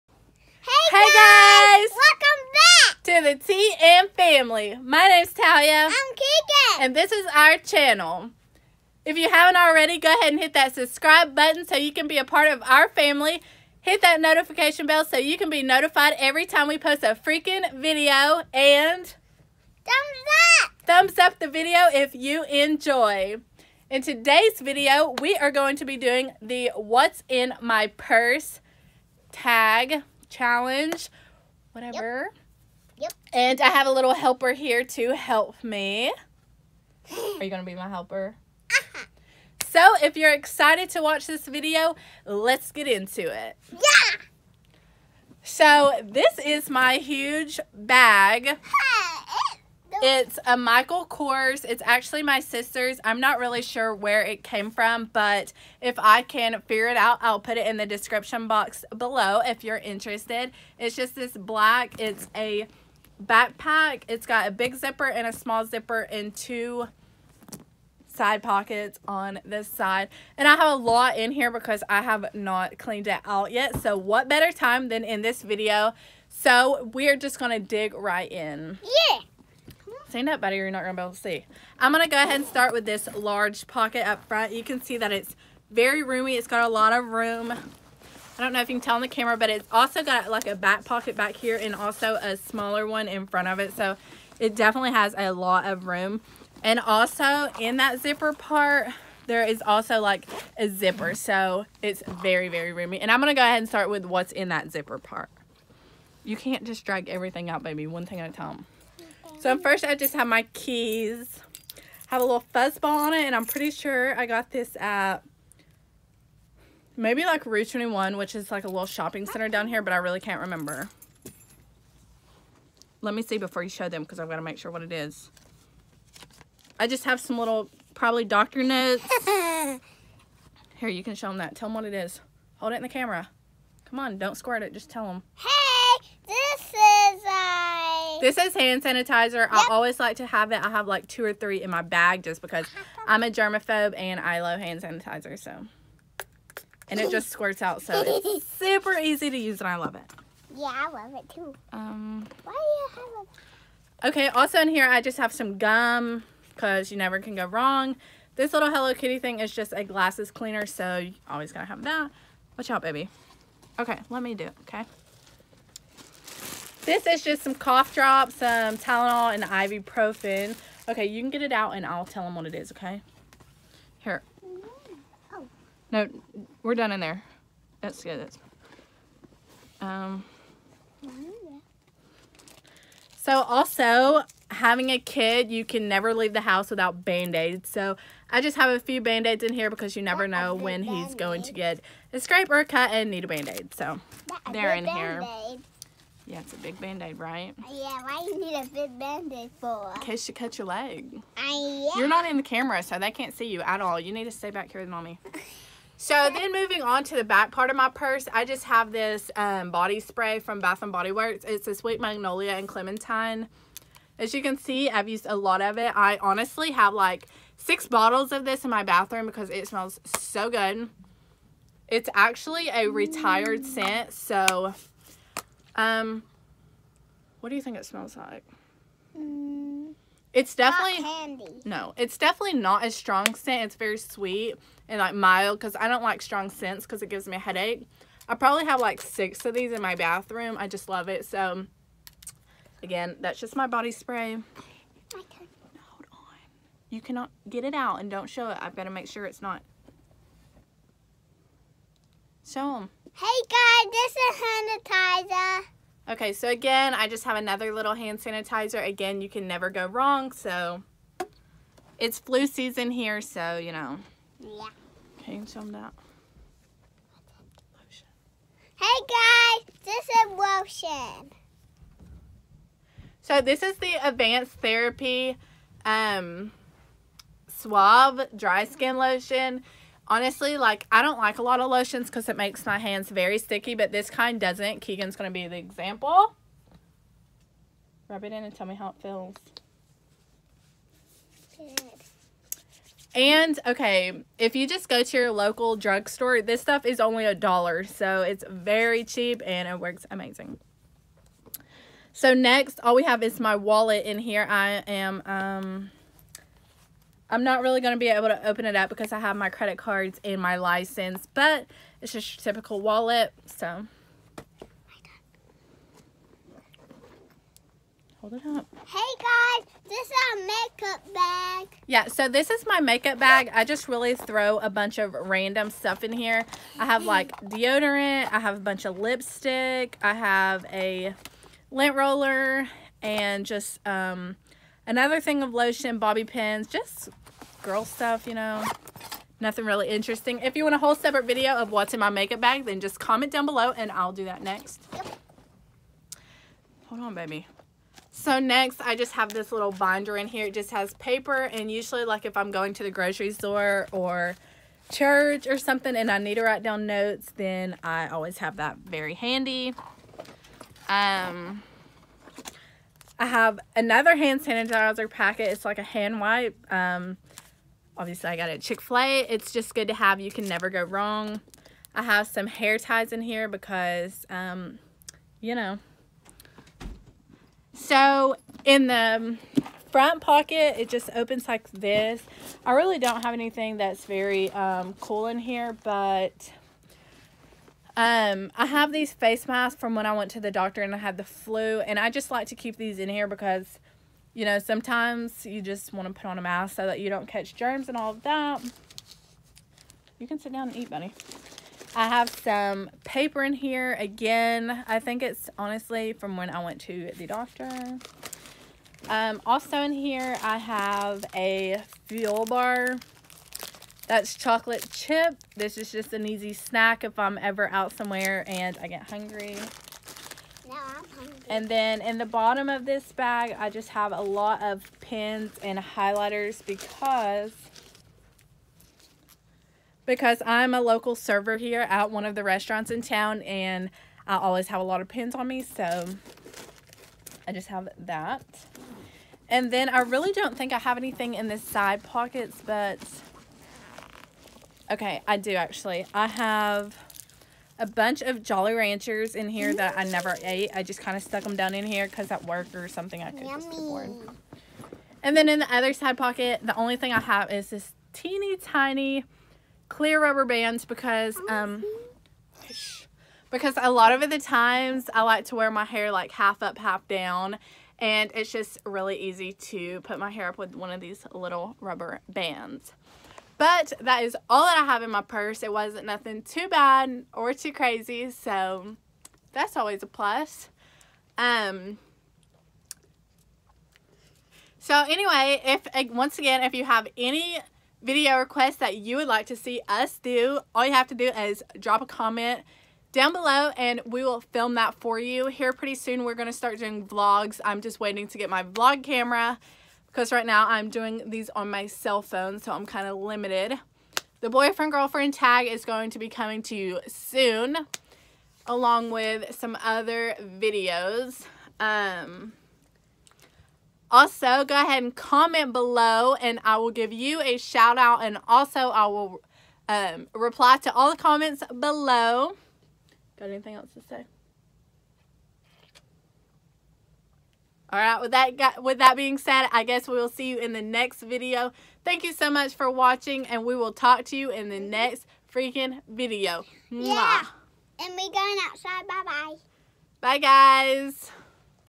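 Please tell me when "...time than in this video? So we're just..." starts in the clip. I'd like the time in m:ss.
1:14.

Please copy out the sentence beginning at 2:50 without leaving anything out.
Okay, you can get it out and I'll tell them what it is, okay?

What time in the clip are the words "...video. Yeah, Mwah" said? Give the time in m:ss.
8:56.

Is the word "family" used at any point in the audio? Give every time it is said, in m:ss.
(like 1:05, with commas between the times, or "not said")
0:04, 0:12.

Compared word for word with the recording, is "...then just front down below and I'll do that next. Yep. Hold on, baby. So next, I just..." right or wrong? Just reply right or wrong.
wrong.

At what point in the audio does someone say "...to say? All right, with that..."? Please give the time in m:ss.
8:43.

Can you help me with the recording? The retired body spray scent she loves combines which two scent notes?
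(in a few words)
Sweet Magnolia and Clementine.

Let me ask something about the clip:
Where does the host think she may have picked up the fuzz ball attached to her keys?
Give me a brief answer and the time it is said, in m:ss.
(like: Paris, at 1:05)
Route 21, at 1:57.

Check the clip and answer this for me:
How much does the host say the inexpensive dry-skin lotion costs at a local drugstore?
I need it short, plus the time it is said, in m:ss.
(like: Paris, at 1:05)
a dollar, at 4:57.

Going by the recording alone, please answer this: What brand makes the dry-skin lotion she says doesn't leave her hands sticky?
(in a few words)
Suave.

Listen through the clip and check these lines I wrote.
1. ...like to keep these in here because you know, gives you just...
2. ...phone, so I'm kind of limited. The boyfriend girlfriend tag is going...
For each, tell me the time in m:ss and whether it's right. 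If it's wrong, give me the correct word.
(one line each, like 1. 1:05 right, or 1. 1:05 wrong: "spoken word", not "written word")
1. 6:32 wrong: "sometimes", not "gives"
2. 8:22 right.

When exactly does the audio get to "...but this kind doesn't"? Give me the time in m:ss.
4:43.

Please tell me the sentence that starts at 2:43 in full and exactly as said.
Okay, let me do it, okay?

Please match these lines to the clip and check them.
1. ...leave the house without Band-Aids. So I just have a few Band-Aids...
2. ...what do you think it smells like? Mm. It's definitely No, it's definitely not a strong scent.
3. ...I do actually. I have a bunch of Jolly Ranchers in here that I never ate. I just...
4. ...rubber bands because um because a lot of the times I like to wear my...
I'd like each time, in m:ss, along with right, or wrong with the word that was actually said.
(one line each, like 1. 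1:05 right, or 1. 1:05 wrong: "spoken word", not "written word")
1. 3:06 right
2. 3:47 right
3. 7:25 right
4. 7:40 right.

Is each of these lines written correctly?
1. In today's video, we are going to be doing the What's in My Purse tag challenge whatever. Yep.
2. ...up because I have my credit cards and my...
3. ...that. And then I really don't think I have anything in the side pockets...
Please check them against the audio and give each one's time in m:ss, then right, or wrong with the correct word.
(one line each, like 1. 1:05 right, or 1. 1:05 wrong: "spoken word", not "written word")
1. 0:23 right
2. 5:08 right
3. 7:17 right.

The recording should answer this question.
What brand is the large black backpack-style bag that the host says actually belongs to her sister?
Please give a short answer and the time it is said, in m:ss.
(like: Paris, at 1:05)
Michael Kors, at 0:50.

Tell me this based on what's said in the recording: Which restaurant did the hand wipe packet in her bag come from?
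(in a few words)
Chick-fil-A.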